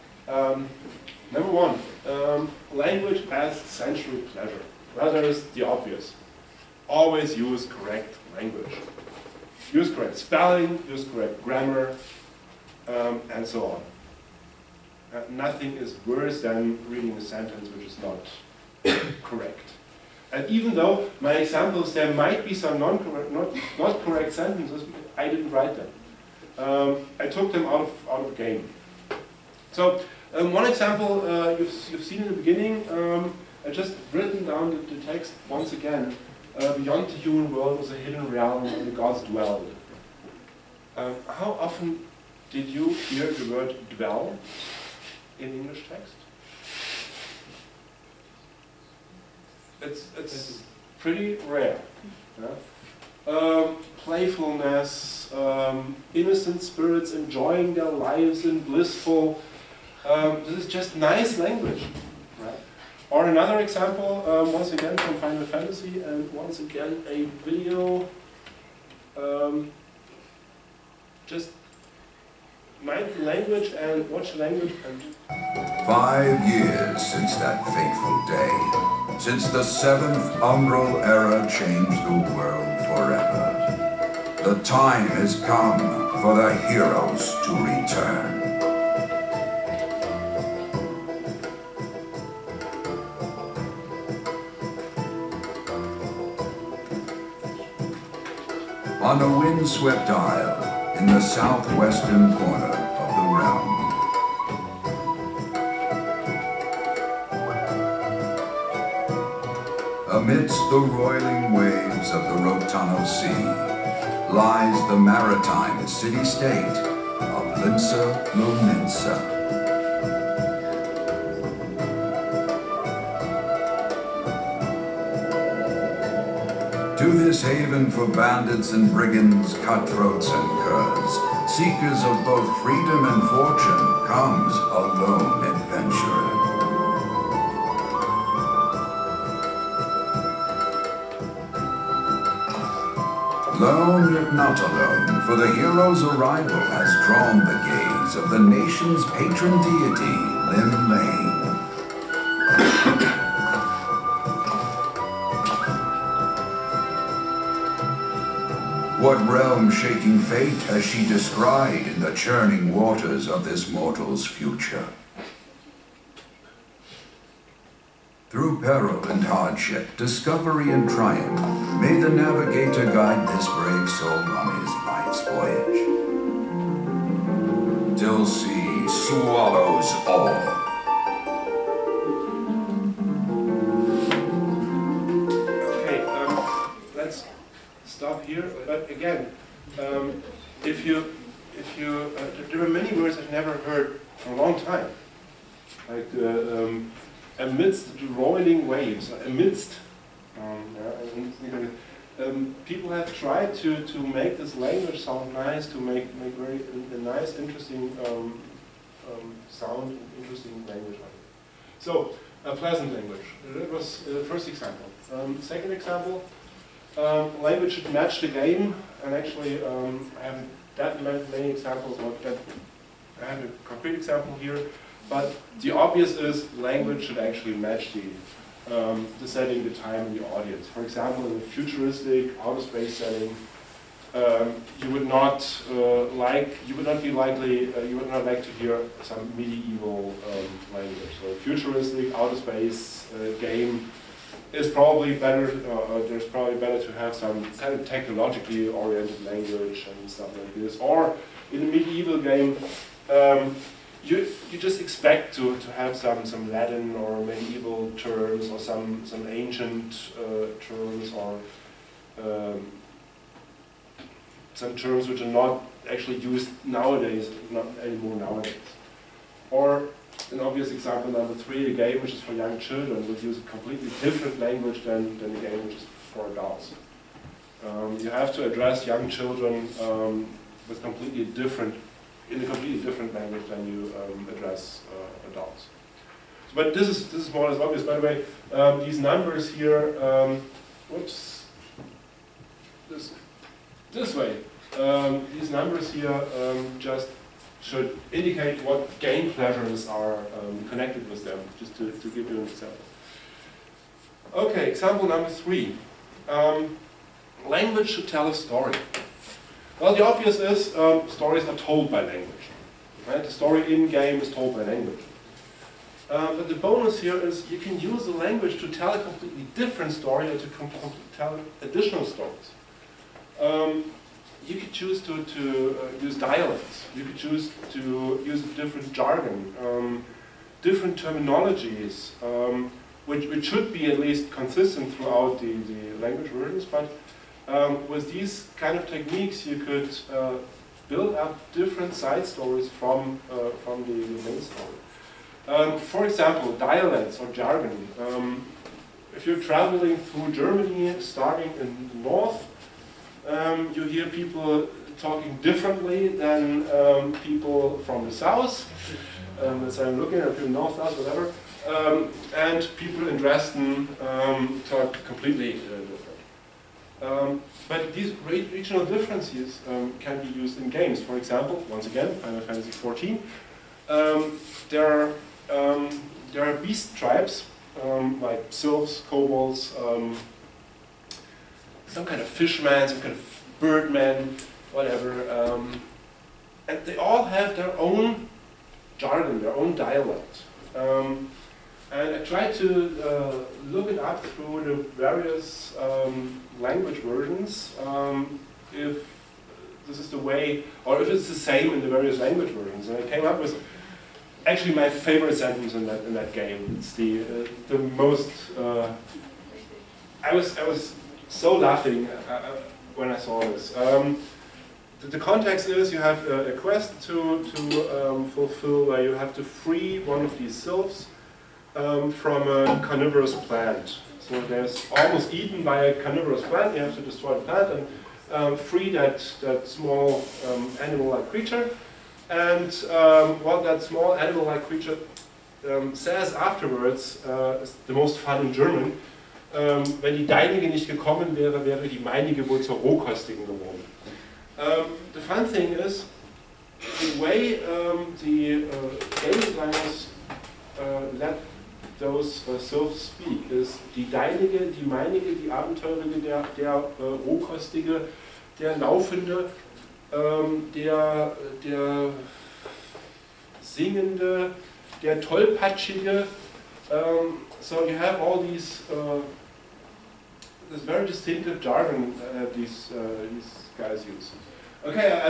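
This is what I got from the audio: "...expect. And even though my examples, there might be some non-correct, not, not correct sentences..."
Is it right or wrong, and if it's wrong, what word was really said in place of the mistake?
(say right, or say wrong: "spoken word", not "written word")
wrong: "correct", not "expect".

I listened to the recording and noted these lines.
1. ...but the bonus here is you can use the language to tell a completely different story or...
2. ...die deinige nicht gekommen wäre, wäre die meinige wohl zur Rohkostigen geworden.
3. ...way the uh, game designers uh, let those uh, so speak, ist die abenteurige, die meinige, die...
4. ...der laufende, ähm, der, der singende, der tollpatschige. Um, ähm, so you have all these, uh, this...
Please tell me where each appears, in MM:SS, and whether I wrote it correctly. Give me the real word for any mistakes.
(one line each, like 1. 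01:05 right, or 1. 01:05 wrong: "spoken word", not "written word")
1. 05:16 right
2. 07:20 right
3. 07:27 wrong: "deinige", not "abenteurige"
4. 07:38 right.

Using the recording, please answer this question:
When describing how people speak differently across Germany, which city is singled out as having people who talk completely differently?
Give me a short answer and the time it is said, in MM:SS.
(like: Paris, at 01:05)
Dresden, at 06:03.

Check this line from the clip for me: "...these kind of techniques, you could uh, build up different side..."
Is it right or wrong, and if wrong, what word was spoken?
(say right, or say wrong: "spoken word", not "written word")
right.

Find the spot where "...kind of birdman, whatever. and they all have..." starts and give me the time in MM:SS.
06:23.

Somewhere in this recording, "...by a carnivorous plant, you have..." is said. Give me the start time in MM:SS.
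07:05.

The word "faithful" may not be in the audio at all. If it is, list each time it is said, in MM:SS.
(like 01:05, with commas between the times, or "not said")
not said.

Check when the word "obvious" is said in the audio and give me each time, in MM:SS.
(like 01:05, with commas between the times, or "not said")
00:05, 03:45, 04:30, 04:47, 05:10.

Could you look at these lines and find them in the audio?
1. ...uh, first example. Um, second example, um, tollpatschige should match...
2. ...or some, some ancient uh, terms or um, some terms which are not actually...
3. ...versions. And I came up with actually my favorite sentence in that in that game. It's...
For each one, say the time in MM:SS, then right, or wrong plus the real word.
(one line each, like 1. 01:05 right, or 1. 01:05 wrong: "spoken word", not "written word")
1. 03:34 wrong: "language", not "tollpatschige"
2. 04:18 right
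3. 06:42 right.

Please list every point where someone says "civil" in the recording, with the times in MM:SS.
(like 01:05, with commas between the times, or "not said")
not said.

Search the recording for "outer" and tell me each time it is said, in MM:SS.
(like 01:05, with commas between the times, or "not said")
03:52, 04:02.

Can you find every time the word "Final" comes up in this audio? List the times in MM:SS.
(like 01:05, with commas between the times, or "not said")
01:05, 06:12.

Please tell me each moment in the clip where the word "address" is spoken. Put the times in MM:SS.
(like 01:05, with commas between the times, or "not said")
04:38, 04:44.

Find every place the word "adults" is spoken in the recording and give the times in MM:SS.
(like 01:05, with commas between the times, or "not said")
04:36, 04:45.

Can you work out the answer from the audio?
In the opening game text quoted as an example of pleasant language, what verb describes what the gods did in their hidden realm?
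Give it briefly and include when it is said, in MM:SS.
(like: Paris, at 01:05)
dwelled, at 00:39.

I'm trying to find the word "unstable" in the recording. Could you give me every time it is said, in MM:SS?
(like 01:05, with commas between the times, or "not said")
not said.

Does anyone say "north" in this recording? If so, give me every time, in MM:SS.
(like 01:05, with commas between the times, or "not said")
05:52, 06:00.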